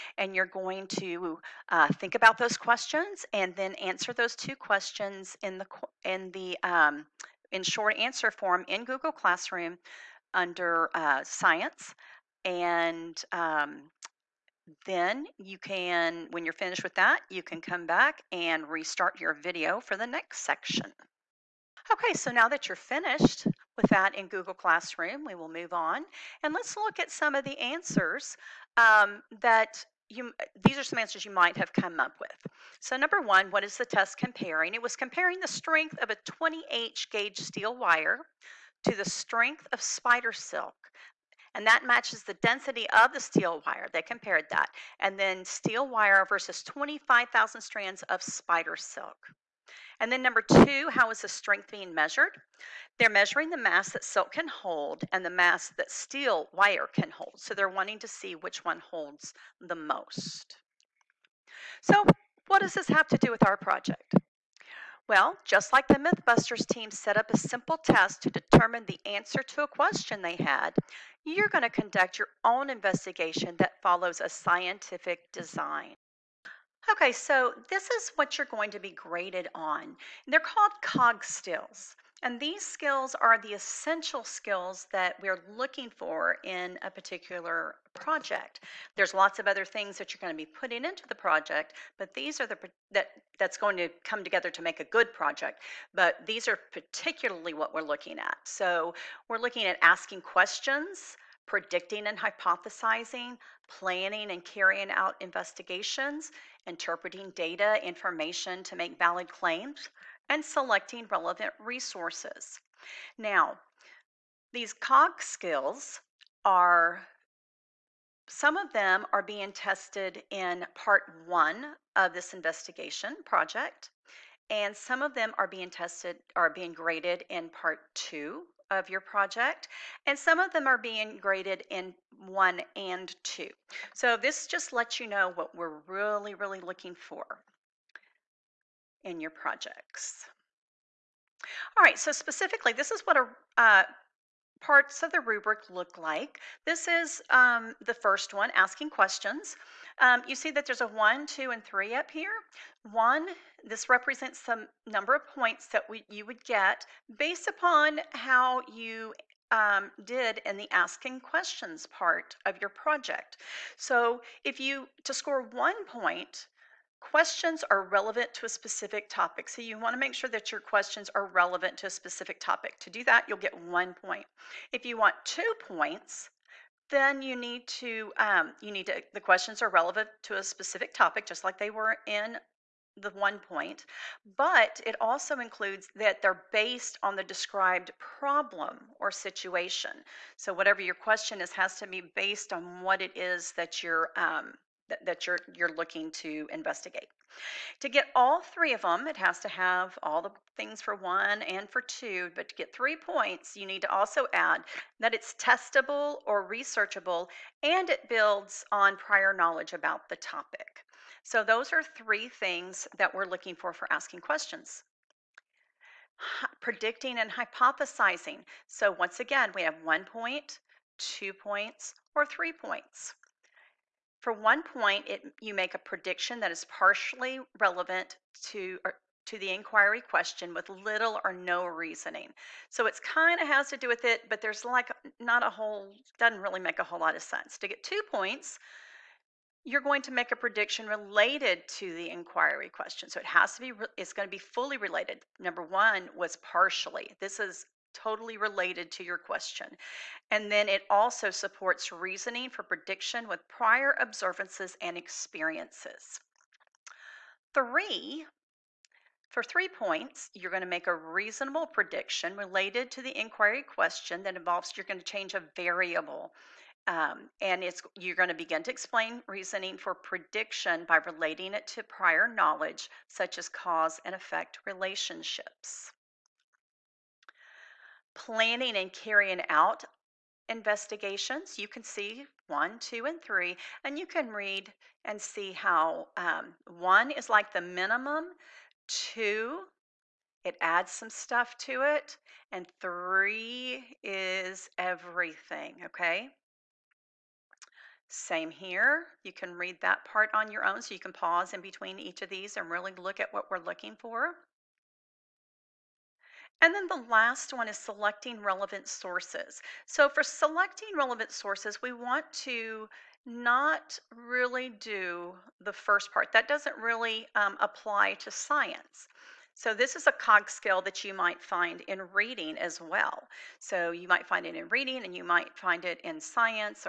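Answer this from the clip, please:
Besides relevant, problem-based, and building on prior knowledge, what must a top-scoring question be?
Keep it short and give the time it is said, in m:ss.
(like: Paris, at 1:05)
testable or researchable, at 3:25.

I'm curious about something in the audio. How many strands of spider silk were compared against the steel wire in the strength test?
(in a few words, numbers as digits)
25,000.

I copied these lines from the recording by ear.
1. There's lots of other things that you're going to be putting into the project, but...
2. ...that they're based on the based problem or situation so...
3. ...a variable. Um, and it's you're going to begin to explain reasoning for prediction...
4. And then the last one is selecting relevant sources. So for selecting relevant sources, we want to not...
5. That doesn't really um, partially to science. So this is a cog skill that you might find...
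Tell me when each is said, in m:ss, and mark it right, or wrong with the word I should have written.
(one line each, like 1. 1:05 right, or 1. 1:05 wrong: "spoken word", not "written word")
1. 1:28 right
2. 3:05 wrong: "described", not "based"
3. 4:25 right
4. 5:06 right
5. 5:16 wrong: "apply", not "partially".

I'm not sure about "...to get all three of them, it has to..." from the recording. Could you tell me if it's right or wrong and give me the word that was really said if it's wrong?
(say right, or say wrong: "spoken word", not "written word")
right.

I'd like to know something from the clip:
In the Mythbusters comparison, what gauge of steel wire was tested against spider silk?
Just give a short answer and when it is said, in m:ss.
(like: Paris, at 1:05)
20, at 0:36.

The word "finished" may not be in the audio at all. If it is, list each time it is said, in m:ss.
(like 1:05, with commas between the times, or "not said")
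0:16, 0:22.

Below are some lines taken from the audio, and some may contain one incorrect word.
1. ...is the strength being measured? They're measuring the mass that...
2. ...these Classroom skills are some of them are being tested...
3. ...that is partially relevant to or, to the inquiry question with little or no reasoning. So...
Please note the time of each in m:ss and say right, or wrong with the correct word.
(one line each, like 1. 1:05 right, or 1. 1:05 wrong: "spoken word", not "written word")
1. 0:51 right
2. 1:54 wrong: "COG", not "Classroom"
3. 3:46 right.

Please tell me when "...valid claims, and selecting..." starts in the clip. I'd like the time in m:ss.
1:48.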